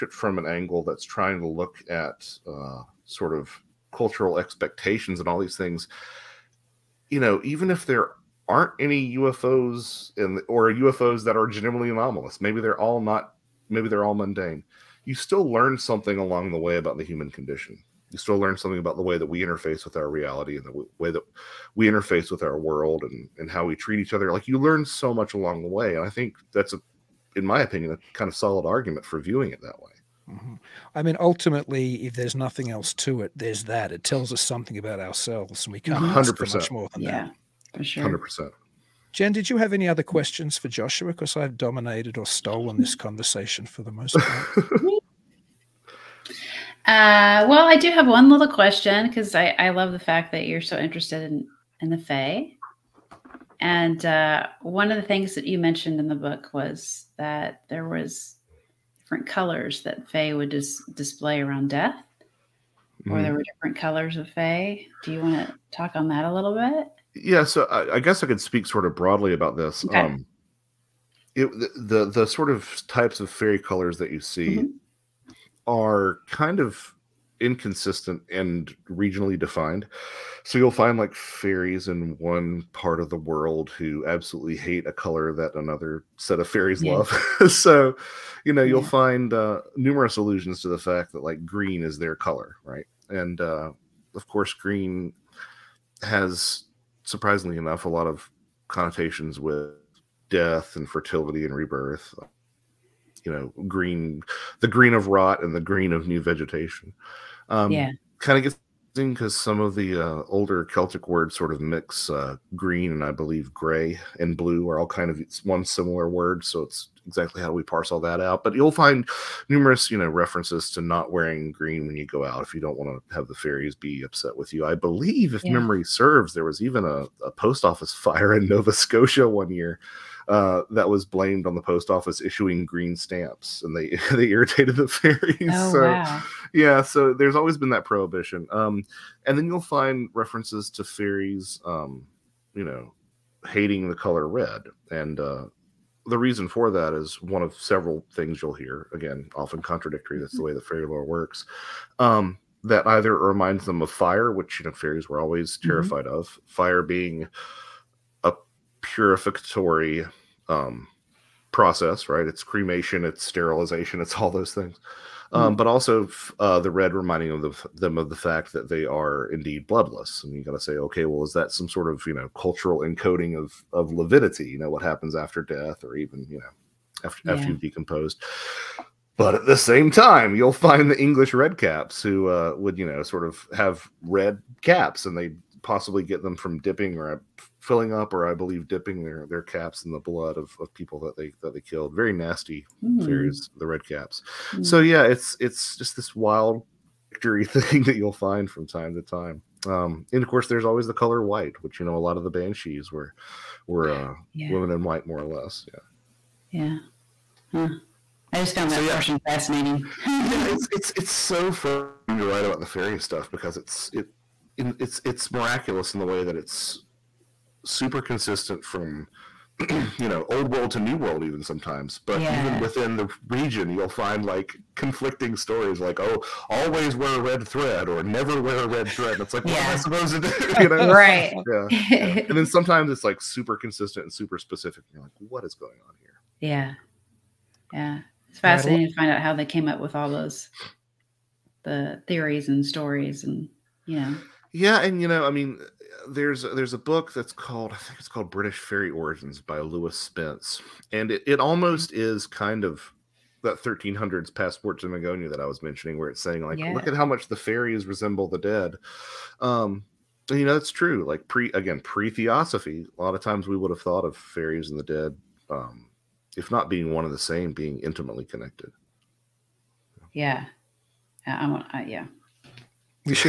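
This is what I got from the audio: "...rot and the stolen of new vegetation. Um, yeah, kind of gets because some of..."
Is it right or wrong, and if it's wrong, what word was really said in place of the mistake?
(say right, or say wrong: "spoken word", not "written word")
wrong: "green", not "stolen".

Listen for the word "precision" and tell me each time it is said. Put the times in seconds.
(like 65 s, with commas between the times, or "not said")
not said.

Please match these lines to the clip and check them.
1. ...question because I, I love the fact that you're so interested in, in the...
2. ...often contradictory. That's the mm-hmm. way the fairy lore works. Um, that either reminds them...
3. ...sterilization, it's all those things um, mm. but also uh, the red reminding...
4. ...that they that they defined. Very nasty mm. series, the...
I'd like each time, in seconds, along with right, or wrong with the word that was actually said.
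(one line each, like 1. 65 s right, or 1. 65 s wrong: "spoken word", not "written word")
1. 48 s right
2. 149 s right
3. 163 s right
4. 191 s wrong: "killed", not "defined".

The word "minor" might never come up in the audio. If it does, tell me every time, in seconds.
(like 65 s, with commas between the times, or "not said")
not said.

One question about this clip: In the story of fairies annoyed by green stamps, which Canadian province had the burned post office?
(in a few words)
Nova Scotia.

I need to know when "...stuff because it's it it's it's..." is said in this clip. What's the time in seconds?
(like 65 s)
212 s.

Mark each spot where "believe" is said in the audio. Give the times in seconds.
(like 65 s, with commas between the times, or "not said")
113 s, 124 s, 188 s.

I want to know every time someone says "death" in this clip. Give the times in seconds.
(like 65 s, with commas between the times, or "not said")
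61 s, 100 s, 175 s.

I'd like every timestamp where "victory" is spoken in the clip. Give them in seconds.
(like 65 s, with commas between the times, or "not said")
197 s.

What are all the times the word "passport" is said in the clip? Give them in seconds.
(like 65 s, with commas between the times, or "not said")
254 s.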